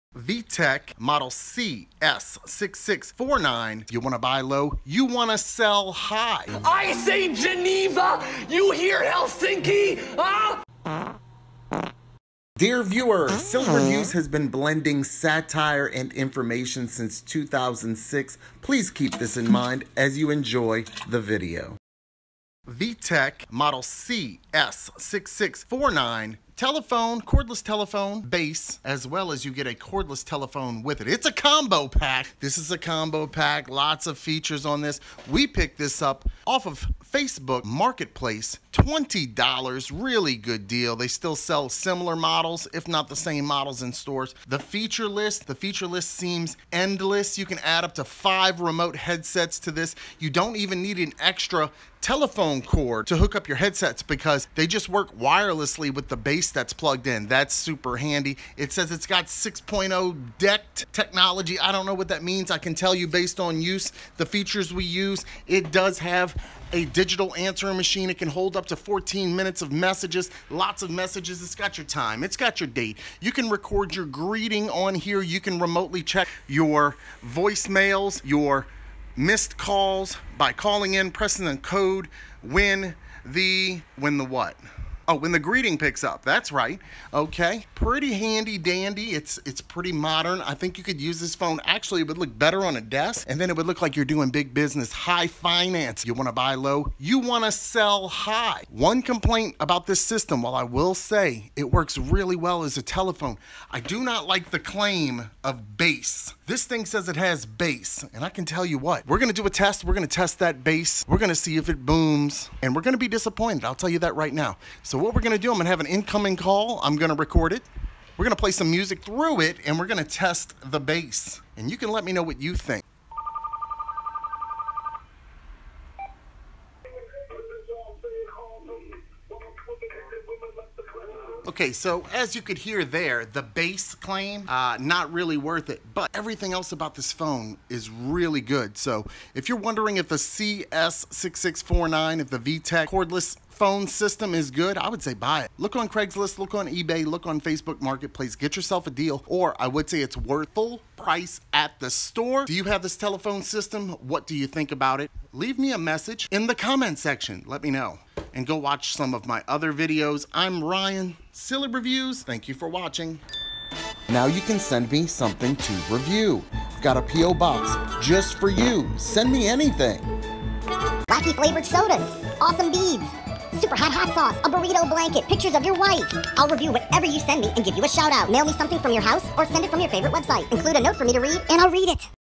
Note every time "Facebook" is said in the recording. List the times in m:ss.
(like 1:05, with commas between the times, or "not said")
0:37, 2:27.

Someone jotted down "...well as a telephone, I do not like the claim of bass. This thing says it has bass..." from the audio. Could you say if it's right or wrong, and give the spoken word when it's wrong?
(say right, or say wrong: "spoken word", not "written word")
right.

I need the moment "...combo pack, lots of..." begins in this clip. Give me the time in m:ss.
0:32.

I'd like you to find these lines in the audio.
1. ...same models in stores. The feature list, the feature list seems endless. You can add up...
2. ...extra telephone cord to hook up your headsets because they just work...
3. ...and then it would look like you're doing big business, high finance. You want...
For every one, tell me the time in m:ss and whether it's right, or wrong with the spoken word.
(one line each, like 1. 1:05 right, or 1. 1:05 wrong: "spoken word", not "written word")
1. 0:43 right
2. 0:51 right
3. 1:33 right.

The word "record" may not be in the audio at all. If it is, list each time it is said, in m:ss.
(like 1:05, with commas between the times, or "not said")
1:13, 1:57.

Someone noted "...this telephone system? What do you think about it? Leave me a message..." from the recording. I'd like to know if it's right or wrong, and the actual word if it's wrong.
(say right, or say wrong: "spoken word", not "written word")
right.